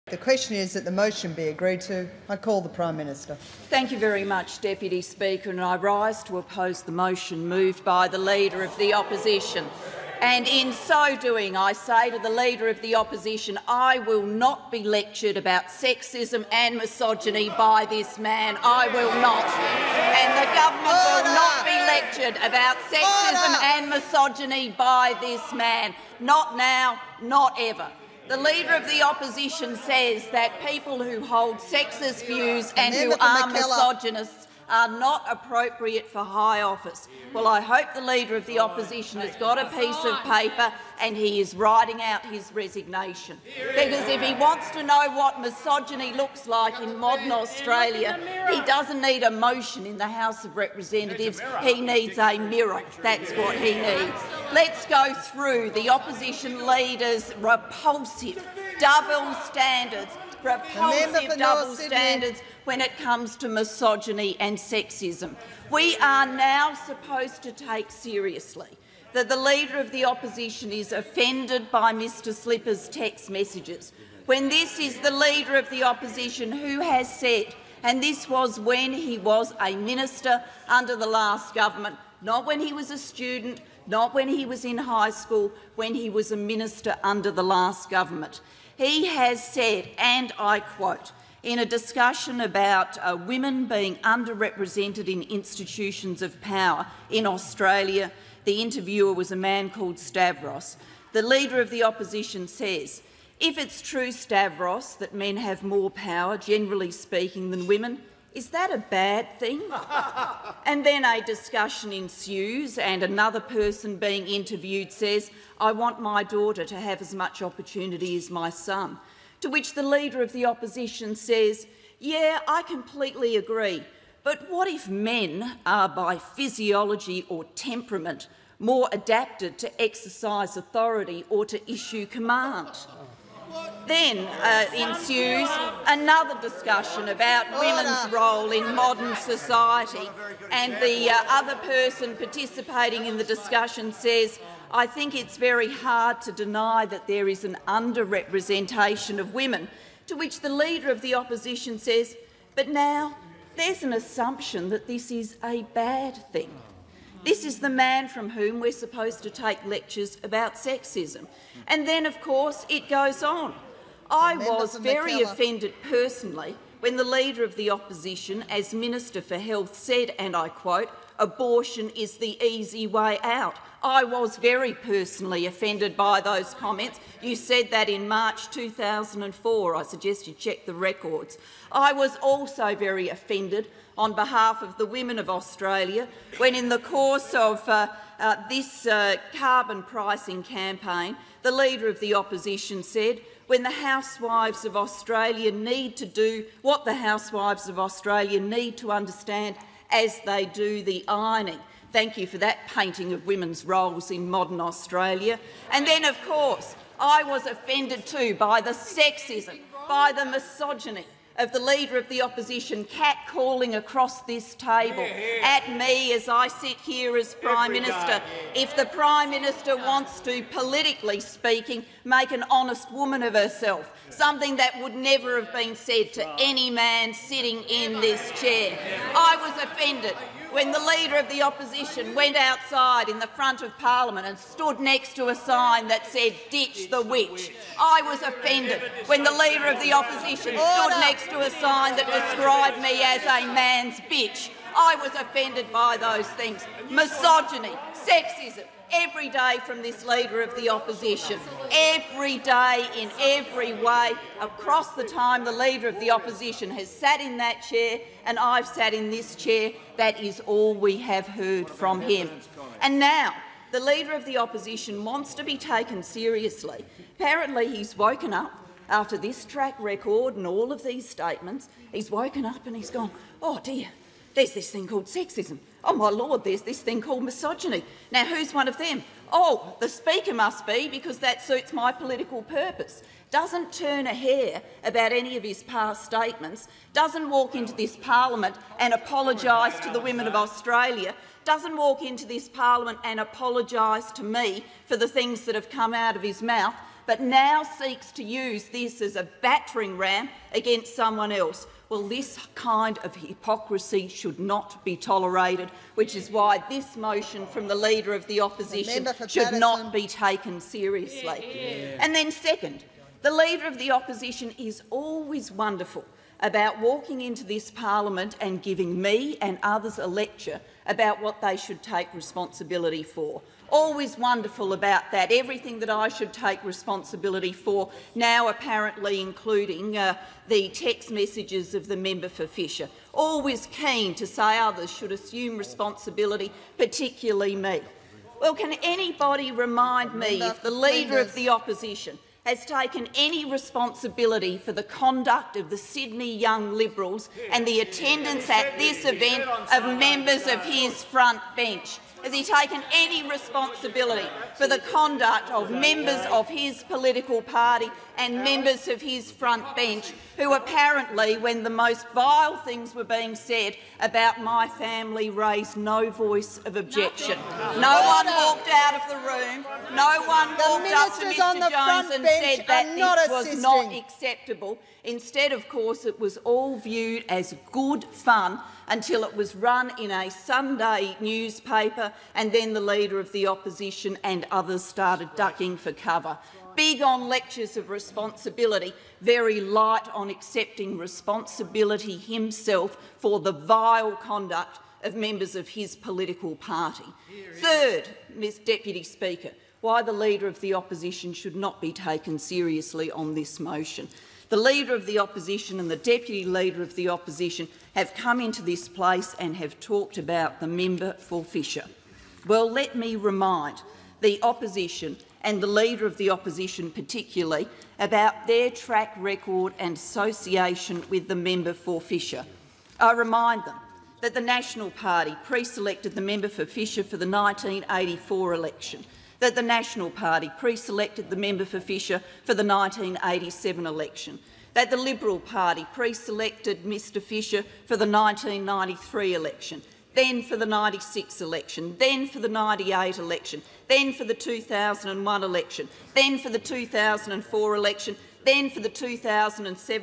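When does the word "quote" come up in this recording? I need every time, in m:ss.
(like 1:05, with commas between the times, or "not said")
1:30, 2:50.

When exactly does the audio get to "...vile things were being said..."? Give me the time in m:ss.
6:02.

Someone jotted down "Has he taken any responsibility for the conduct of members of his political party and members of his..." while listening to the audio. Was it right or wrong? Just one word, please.
right.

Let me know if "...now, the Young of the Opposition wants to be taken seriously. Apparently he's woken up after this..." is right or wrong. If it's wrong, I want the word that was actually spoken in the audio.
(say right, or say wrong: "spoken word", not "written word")
wrong: "Leader", not "Young".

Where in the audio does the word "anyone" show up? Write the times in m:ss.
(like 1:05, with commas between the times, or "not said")
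not said.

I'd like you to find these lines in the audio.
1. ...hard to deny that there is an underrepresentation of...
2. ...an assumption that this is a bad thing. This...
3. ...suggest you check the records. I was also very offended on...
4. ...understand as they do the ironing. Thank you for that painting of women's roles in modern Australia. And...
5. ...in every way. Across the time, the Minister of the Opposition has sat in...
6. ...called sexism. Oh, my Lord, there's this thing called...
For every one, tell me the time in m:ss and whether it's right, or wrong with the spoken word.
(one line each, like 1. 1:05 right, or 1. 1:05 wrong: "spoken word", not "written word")
1. 2:25 right
2. 2:33 right
3. 2:59 right
4. 3:18 right
5. 4:12 wrong: "Leader", not "Minister"
6. 4:34 right.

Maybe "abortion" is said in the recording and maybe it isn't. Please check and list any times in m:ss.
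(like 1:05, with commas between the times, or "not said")
2:51.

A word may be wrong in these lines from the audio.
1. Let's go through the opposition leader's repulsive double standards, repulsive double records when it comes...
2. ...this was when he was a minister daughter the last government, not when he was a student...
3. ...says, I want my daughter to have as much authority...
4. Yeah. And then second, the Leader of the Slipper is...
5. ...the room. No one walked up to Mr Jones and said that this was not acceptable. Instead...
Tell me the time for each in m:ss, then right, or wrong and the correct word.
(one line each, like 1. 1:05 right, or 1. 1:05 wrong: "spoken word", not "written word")
1. 0:54 wrong: "standards", not "records"
2. 1:18 wrong: "under", not "daughter"
3. 1:54 wrong: "opportunity", not "authority"
4. 5:11 wrong: "Opposition", not "Slipper"
5. 6:09 right.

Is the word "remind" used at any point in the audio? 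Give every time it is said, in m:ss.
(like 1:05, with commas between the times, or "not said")
5:39, 6:53, 7:03.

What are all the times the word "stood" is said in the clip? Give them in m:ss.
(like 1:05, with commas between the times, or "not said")
3:54, 4:00.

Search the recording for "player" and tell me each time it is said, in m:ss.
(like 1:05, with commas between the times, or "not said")
not said.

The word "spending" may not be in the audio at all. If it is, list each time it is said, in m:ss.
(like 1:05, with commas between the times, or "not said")
not said.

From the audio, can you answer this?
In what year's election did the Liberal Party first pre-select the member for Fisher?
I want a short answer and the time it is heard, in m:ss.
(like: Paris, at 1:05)
1993, at 7:18.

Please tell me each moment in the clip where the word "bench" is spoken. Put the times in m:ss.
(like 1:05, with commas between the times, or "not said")
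5:51, 5:59.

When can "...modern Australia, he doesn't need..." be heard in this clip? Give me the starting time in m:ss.
0:46.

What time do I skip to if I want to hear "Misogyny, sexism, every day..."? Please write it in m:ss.
4:06.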